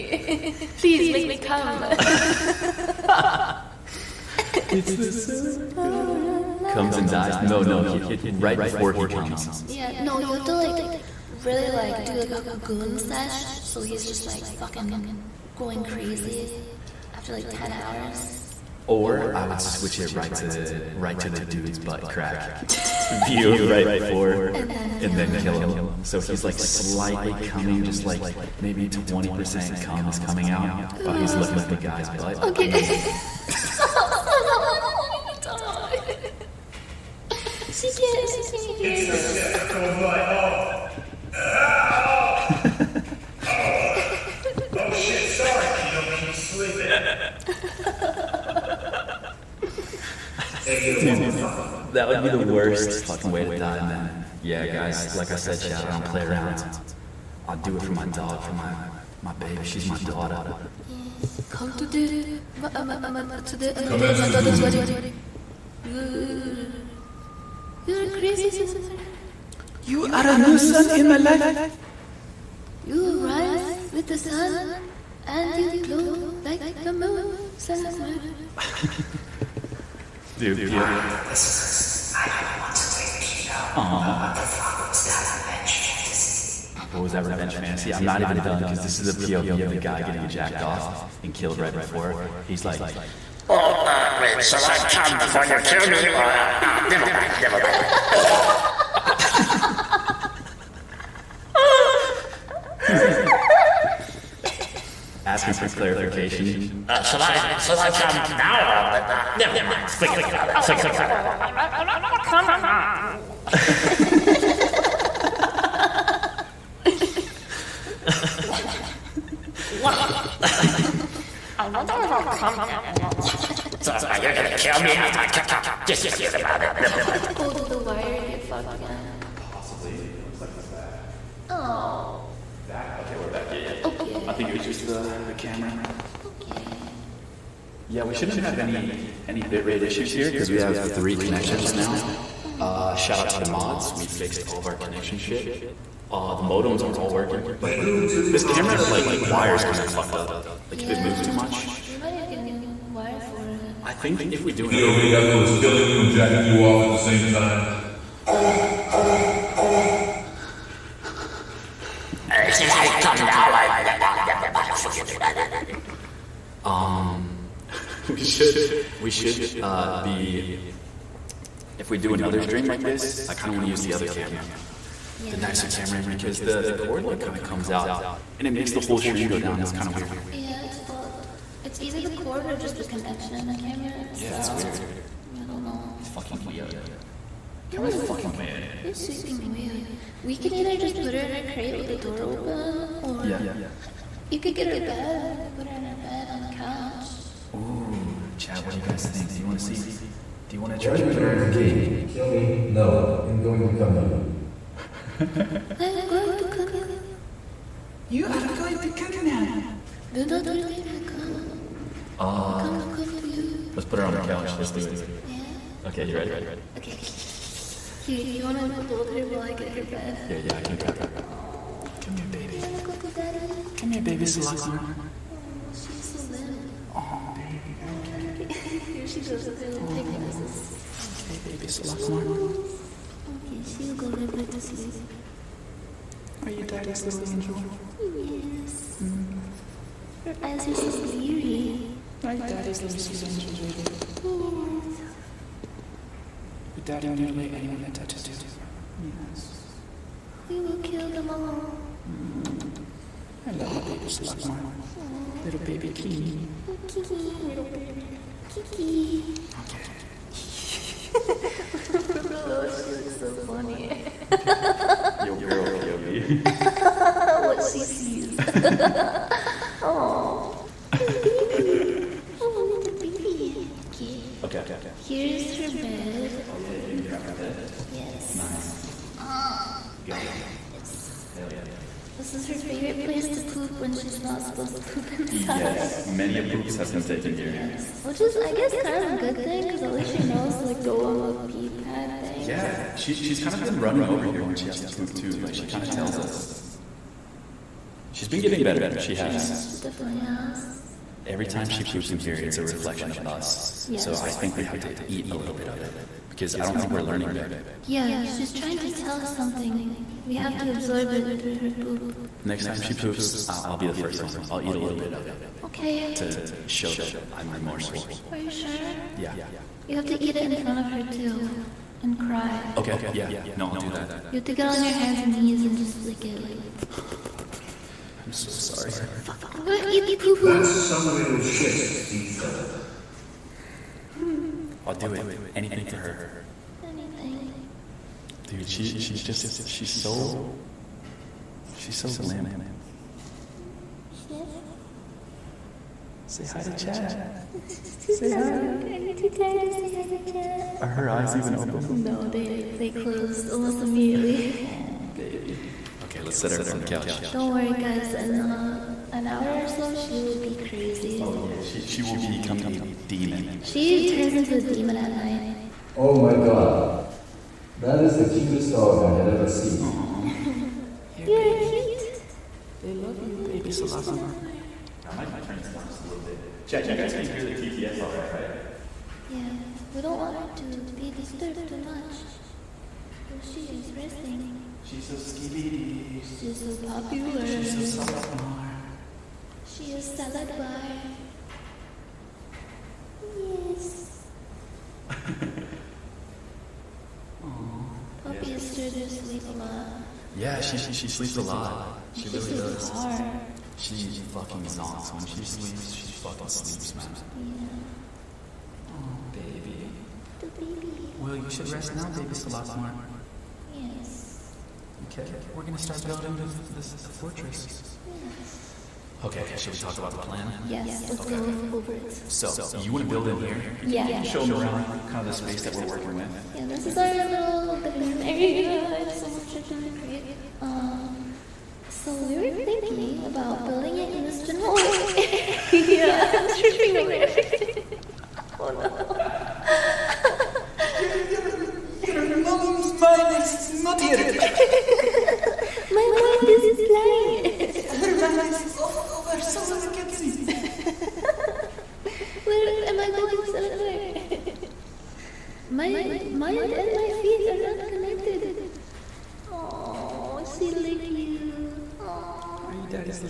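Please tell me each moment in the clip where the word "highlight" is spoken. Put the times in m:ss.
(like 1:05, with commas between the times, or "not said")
not said.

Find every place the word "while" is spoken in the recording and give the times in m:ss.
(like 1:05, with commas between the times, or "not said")
0:31, 3:39.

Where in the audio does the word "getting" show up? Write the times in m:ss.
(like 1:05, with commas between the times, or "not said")
1:30, 4:58.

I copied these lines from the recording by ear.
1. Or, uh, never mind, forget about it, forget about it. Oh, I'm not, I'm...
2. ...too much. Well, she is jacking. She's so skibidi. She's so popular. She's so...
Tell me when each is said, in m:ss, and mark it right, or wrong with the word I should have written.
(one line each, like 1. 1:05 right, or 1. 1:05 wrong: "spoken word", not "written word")
1. 1:48 right
2. 6:21 wrong: "resting", not "jacking".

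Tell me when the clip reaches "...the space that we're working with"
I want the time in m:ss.
7:05.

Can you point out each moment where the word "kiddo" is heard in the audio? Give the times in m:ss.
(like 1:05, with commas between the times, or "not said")
0:45.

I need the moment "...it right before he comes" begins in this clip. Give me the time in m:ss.
0:08.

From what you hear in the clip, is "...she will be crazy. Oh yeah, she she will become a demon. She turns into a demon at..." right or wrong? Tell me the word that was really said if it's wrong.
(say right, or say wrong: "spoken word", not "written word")
right.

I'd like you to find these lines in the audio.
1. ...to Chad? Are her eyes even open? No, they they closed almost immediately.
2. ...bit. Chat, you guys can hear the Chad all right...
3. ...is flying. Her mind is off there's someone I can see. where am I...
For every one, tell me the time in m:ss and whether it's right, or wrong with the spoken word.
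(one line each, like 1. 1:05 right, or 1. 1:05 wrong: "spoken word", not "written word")
1. 5:50 right
2. 6:16 wrong: "TTS", not "Chad"
3. 7:26 right.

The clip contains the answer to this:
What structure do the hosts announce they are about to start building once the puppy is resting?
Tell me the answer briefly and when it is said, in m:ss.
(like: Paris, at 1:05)
Fortress, at 6:57.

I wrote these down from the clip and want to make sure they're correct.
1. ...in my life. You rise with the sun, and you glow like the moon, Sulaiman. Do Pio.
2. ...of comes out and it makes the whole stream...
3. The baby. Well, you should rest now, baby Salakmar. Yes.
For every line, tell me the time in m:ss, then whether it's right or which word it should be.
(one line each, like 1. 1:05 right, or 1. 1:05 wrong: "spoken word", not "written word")
1. 1:10 right
2. 2:57 right
3. 6:50 right.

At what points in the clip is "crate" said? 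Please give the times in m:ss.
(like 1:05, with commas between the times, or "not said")
3:11, 7:10.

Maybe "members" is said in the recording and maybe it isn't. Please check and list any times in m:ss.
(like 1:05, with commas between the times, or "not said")
not said.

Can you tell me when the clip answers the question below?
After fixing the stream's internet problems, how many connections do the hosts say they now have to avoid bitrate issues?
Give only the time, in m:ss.
2:20.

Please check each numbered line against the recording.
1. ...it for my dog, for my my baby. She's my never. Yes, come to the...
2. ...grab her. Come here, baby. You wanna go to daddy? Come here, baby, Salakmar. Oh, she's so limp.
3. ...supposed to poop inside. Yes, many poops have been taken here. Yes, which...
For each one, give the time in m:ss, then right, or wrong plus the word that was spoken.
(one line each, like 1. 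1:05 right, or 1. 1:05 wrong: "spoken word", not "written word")
1. 0:57 wrong: "daughter", not "never"
2. 3:40 right
3. 4:44 right.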